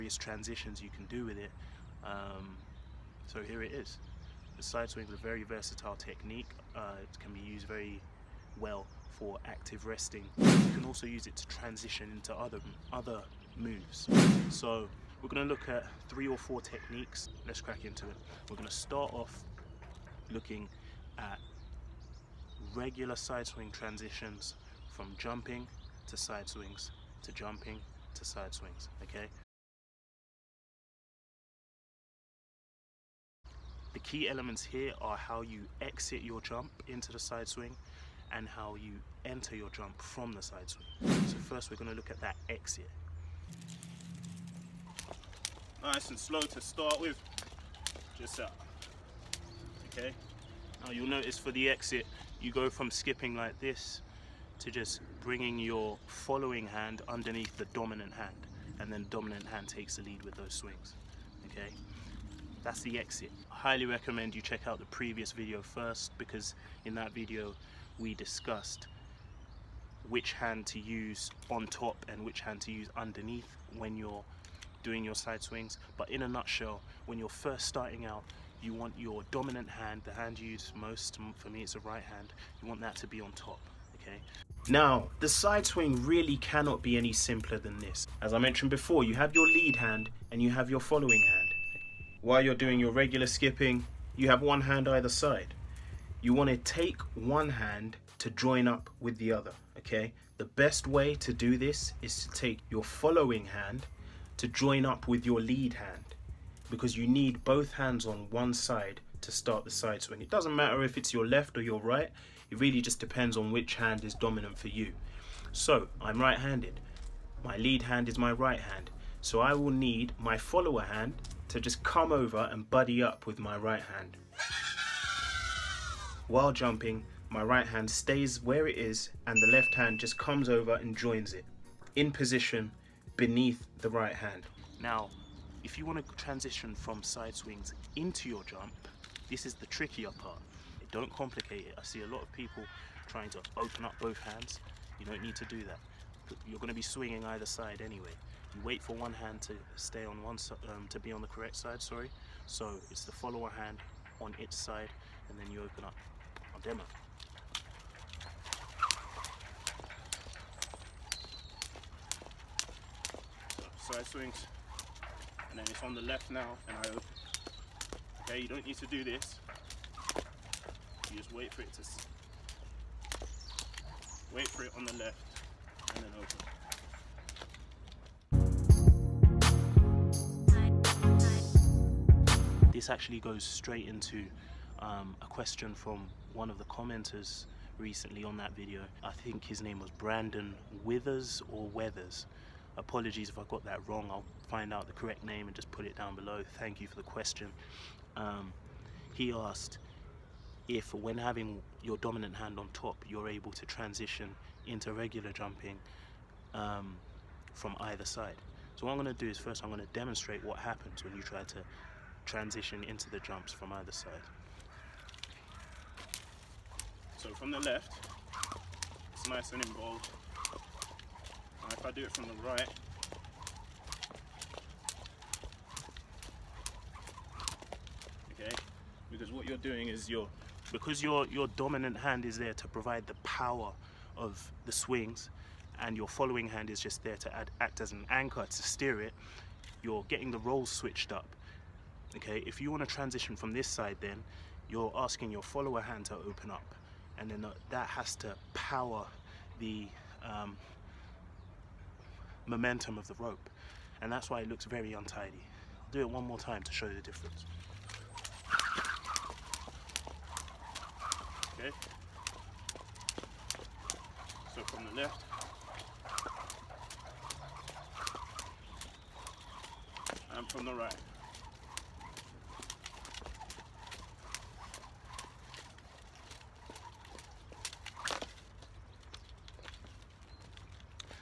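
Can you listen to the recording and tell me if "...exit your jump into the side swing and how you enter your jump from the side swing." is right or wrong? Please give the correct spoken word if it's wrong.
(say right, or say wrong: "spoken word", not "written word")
right.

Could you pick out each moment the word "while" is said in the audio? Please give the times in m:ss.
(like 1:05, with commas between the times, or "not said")
1:32, 2:06.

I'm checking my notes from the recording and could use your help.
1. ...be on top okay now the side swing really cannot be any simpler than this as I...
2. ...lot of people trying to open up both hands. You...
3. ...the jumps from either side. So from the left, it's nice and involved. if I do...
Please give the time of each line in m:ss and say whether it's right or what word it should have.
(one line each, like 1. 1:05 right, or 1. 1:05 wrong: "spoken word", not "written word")
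1. 1:23 right
2. 2:22 right
3. 3:33 right.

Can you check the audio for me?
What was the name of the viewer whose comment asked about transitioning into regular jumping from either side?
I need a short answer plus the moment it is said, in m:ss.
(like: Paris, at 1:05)
Brandon Withers, at 3:09.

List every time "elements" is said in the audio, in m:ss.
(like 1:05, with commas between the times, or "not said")
0:34.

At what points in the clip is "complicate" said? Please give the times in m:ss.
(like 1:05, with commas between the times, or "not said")
2:21.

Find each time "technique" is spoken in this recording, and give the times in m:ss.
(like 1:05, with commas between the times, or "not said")
0:05, 0:16.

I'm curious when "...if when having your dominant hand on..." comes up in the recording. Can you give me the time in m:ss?
3:20.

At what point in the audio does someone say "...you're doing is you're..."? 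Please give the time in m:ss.
3:49.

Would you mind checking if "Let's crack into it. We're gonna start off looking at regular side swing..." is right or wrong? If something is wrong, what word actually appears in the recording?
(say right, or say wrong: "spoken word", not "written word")
right.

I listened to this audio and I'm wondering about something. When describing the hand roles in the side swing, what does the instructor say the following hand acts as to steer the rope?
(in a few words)
an anchor.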